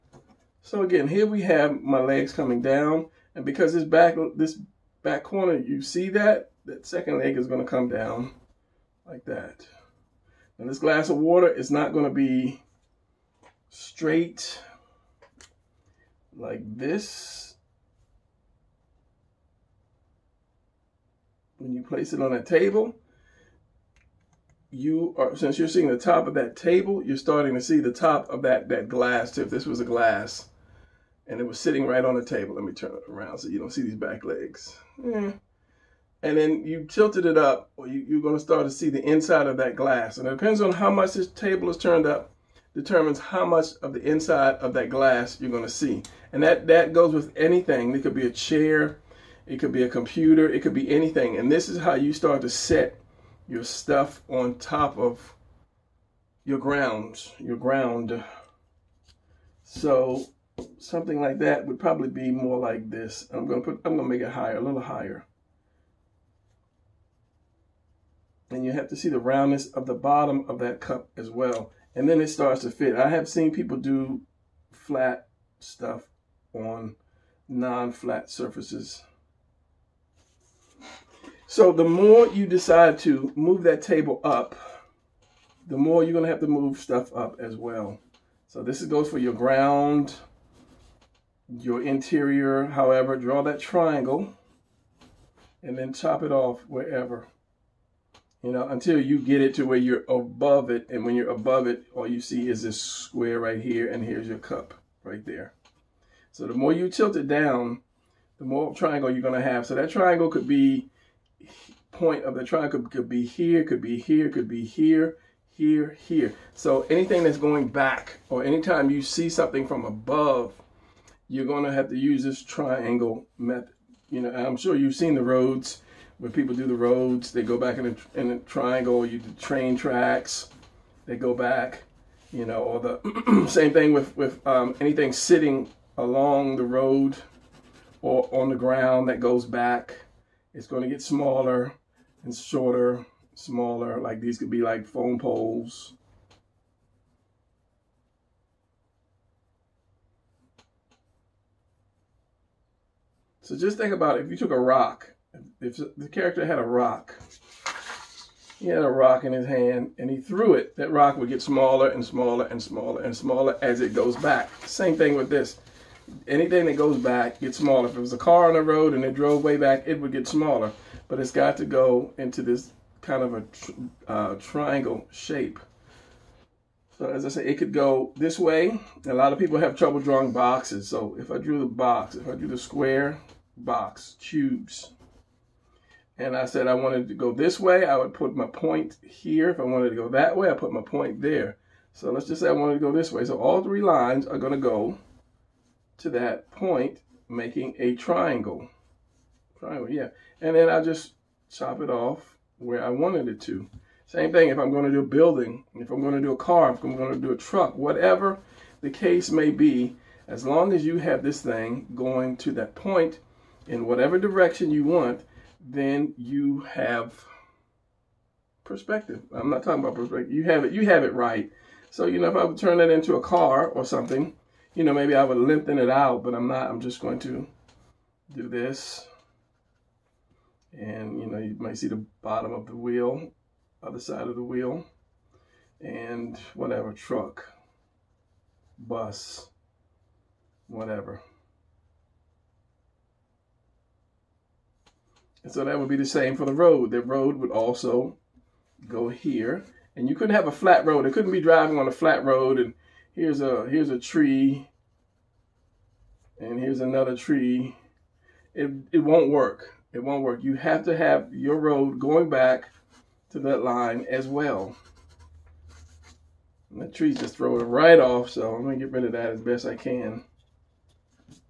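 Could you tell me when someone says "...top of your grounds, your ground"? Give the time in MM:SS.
00:54.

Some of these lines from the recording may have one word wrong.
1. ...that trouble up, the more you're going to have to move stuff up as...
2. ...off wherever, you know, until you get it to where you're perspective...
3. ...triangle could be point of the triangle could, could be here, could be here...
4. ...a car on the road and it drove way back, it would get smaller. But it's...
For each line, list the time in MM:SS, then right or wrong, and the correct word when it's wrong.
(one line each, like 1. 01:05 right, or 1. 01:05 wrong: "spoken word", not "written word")
1. 01:23 wrong: "table", not "trouble"
2. 01:36 wrong: "above", not "perspective"
3. 01:49 right
4. 02:48 right.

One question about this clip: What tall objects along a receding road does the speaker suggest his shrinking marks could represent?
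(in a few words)
Phone poles.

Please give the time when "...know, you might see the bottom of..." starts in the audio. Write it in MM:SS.
03:51.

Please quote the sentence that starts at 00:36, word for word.
And then you tilted it up, or you, you're gonna start to see the inside of that glass.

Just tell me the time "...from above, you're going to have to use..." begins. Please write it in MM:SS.
01:59.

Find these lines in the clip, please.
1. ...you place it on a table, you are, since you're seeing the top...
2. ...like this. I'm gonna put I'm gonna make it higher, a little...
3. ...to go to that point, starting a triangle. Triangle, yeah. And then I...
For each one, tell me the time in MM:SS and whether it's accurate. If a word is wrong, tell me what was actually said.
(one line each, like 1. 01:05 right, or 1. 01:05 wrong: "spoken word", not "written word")
1. 00:21 right
2. 01:02 right
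3. 03:14 wrong: "making", not "starting".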